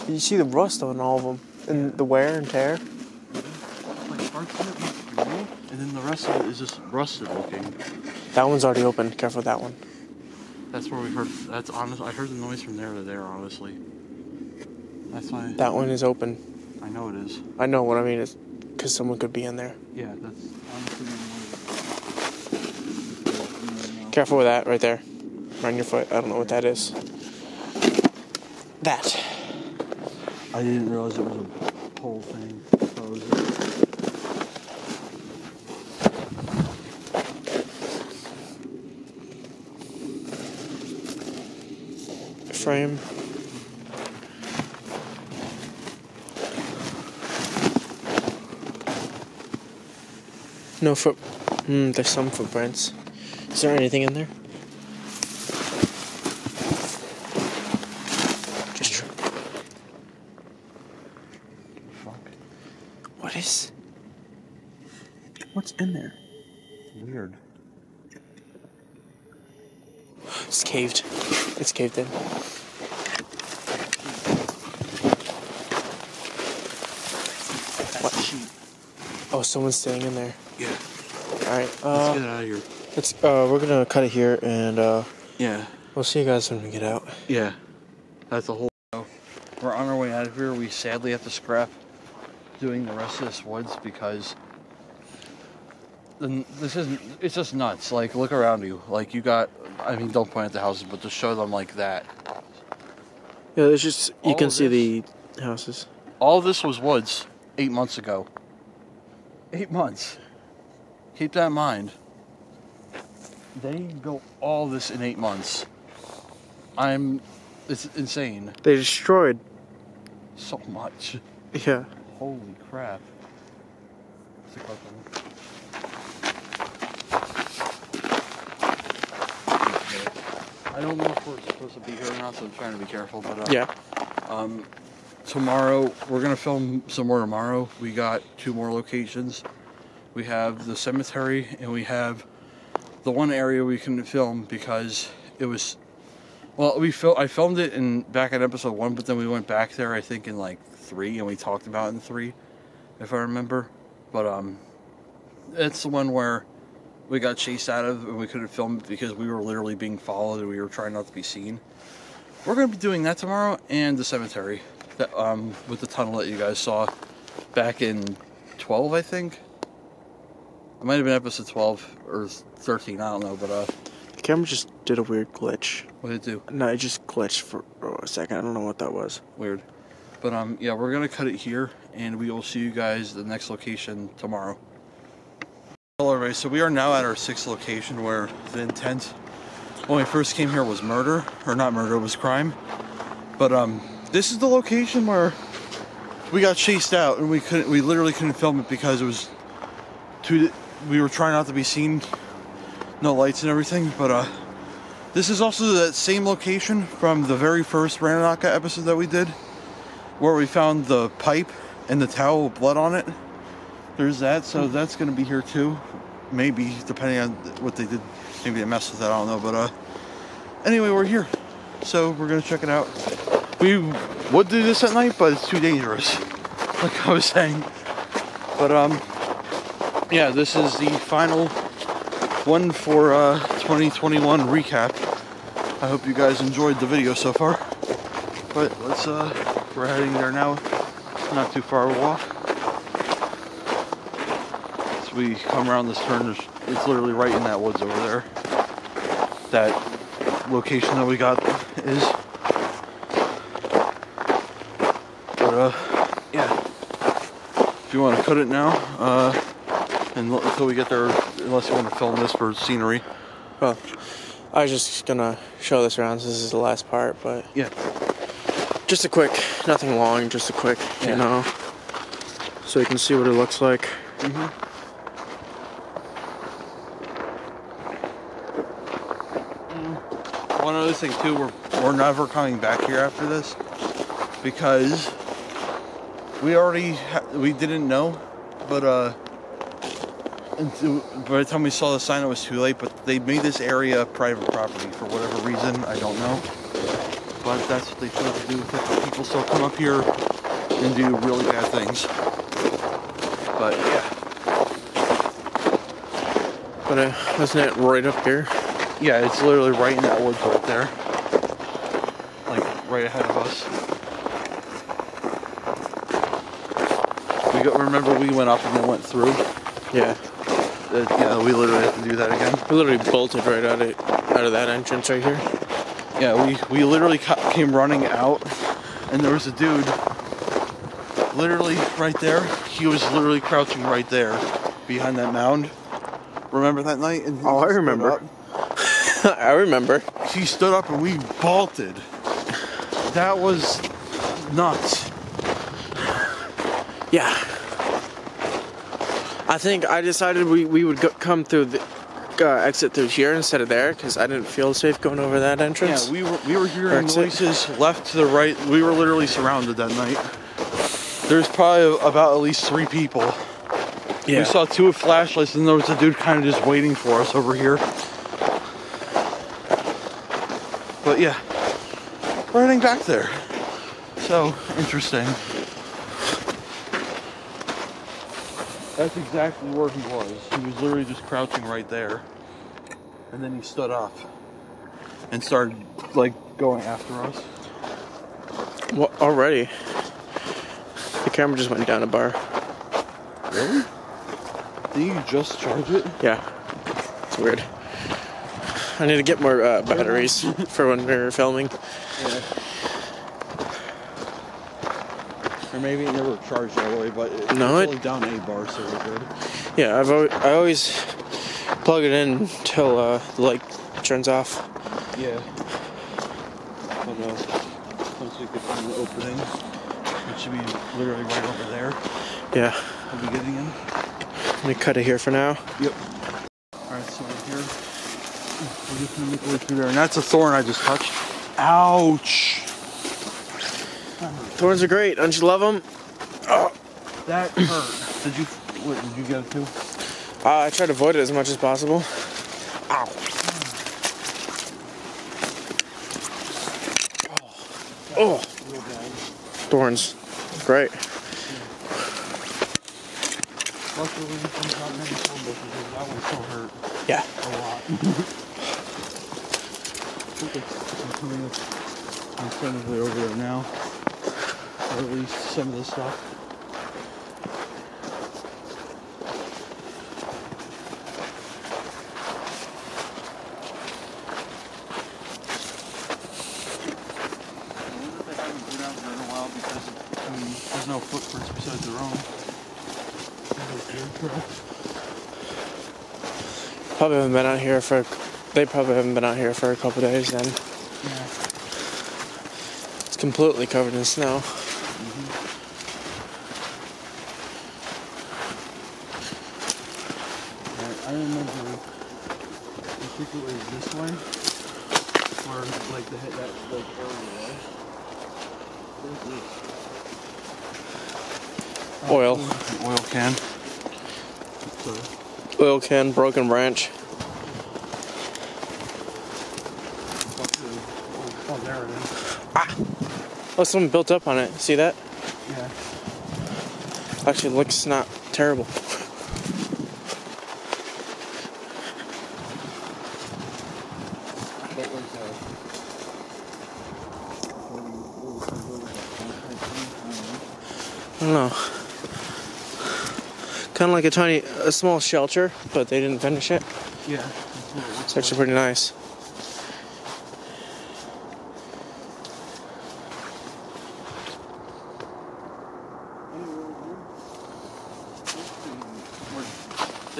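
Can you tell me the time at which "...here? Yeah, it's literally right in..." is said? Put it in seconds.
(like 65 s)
308 s.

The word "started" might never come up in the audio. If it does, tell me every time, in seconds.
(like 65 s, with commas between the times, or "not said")
385 s.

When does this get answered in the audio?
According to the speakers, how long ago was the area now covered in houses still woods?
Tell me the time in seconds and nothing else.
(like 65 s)
107 s.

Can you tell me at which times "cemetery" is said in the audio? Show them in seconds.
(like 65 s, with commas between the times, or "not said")
140 s, 164 s.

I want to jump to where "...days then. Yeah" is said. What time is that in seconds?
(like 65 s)
490 s.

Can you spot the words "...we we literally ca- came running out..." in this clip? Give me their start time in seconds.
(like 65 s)
326 s.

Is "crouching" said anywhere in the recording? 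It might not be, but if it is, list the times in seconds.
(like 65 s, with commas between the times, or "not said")
333 s, 381 s.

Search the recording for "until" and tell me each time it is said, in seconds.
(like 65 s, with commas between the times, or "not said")
260 s, 412 s.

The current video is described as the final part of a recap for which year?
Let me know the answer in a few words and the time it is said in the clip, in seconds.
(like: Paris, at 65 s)
2021, at 233 s.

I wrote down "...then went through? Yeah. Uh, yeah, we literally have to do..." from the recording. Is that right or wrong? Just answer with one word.
right.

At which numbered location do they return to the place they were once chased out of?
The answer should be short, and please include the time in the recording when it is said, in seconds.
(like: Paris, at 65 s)
sixth, at 187 s.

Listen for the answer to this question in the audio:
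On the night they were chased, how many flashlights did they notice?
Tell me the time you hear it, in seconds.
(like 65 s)
364 s.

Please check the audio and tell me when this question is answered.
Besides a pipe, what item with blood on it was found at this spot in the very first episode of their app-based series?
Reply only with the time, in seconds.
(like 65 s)
212 s.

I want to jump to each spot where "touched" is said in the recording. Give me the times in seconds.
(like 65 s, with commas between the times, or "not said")
430 s.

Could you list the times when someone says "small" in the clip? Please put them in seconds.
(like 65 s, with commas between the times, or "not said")
544 s.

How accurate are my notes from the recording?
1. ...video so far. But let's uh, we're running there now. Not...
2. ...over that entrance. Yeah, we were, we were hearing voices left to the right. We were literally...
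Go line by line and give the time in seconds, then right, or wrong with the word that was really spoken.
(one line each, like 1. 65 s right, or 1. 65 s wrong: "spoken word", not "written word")
1. 236 s wrong: "heading", not "running"
2. 355 s right.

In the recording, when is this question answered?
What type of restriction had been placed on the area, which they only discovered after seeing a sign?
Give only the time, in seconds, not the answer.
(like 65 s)
294 s.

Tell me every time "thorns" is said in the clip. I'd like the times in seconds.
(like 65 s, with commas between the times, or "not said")
430 s, 434 s, 449 s.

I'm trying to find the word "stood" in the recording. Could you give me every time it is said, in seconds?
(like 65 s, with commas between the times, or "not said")
340 s, 383 s.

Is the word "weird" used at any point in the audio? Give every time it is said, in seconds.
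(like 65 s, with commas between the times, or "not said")
67 s, 175 s, 179 s, 397 s.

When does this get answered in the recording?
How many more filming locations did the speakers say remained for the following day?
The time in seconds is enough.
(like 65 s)
138 s.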